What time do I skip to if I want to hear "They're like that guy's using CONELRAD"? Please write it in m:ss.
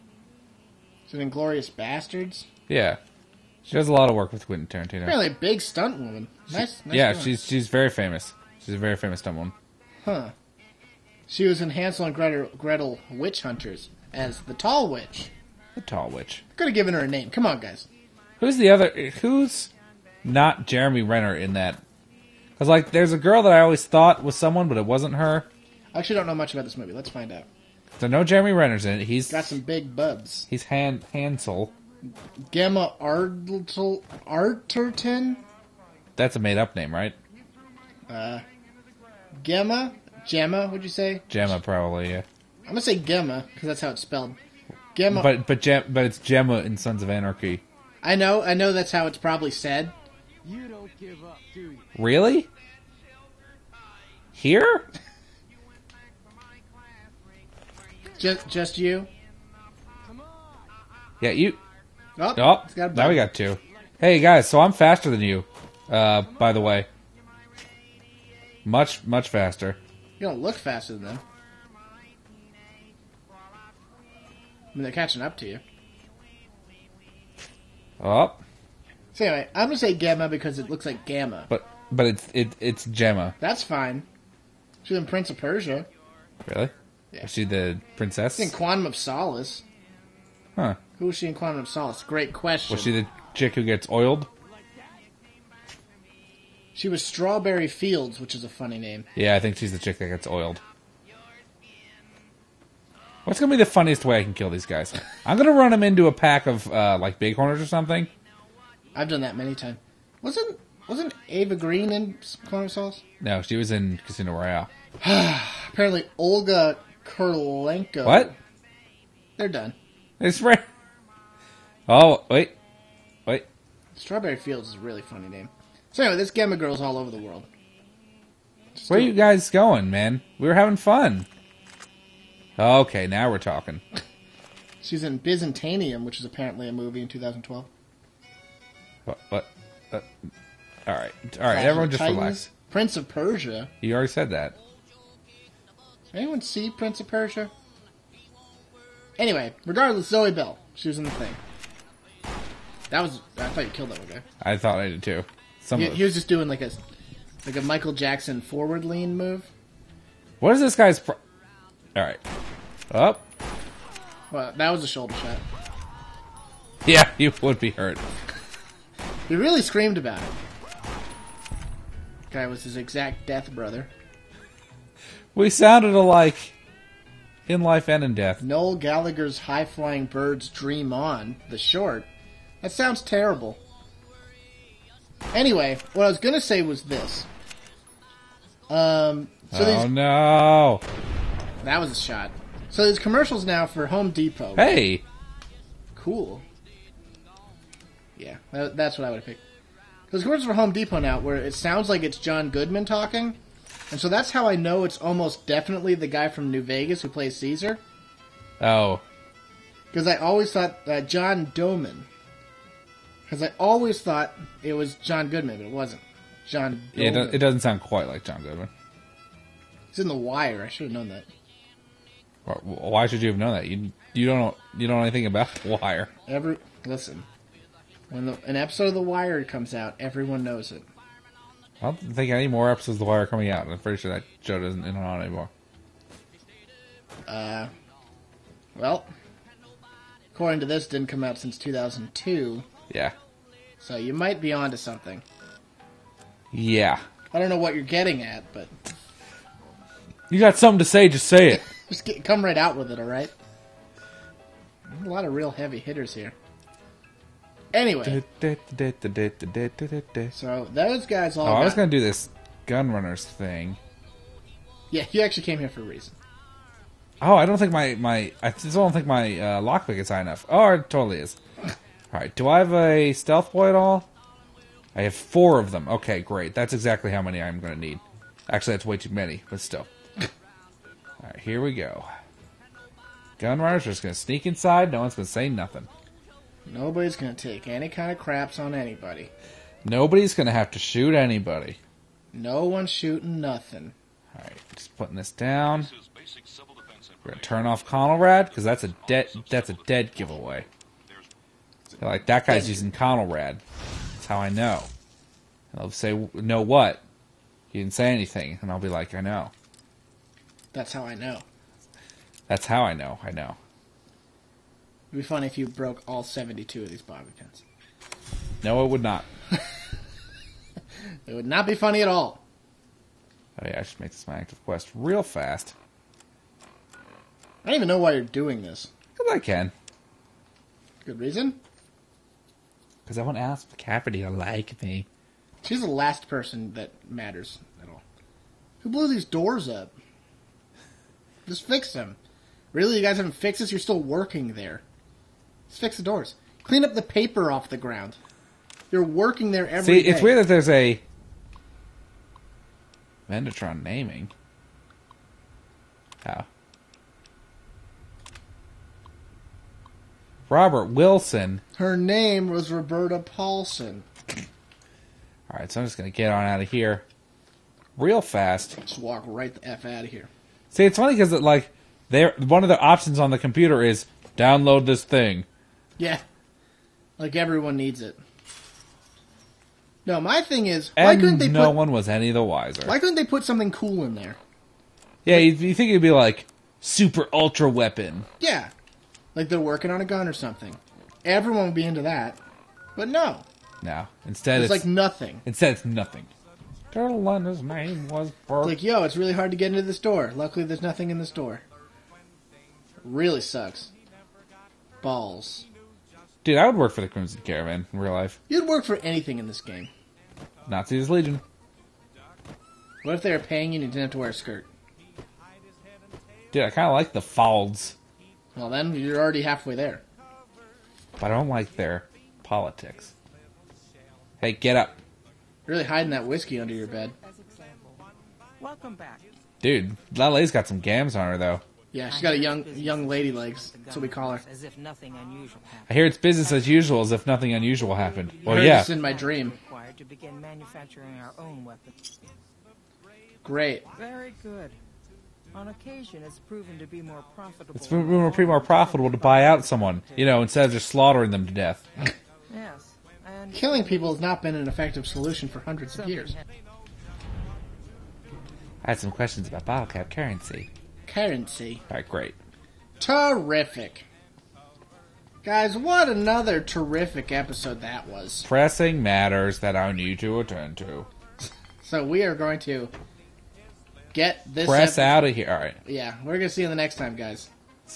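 5:01.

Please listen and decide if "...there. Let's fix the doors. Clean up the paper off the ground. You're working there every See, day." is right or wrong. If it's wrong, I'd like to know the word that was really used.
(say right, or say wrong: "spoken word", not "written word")
right.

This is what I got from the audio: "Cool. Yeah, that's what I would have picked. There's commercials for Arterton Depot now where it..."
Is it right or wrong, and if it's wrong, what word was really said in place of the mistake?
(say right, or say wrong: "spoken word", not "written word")
wrong: "Home", not "Arterton".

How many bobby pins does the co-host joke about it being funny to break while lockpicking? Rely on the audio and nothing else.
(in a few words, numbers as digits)
72.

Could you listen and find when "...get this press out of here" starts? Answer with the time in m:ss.
7:54.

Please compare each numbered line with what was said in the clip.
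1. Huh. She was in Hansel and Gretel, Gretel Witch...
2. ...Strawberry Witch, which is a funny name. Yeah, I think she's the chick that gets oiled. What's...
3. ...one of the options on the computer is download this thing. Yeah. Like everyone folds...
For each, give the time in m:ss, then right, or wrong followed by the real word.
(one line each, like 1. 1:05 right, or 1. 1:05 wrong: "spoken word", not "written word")
1. 0:10 right
2. 1:37 wrong: "Fields", not "Witch"
3. 6:12 wrong: "needs", not "folds".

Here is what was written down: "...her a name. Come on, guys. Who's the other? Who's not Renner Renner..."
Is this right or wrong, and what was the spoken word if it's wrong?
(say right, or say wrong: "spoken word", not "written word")
wrong: "Jeremy", not "Renner".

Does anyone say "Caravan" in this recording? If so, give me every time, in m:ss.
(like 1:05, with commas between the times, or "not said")
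6:47.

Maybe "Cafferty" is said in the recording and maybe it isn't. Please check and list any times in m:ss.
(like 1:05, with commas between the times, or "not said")
5:33.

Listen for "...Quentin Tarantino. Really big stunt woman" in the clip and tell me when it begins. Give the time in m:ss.
0:04.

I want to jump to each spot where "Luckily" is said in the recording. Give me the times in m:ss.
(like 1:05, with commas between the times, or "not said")
6:40.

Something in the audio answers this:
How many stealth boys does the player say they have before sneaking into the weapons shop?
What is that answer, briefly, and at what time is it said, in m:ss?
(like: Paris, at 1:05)
4, at 4:35.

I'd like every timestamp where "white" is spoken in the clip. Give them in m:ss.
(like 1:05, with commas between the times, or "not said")
not said.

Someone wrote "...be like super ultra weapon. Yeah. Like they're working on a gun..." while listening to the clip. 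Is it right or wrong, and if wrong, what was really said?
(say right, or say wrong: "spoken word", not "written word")
right.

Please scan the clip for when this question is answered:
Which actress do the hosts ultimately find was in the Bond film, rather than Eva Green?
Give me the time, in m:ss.
1:56.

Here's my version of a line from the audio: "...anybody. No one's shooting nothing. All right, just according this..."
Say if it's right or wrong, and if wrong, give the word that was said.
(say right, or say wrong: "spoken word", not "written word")
wrong: "putting", not "according".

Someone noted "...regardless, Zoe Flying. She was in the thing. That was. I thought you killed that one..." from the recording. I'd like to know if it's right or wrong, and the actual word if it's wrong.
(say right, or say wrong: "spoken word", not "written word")
wrong: "Bell", not "Flying".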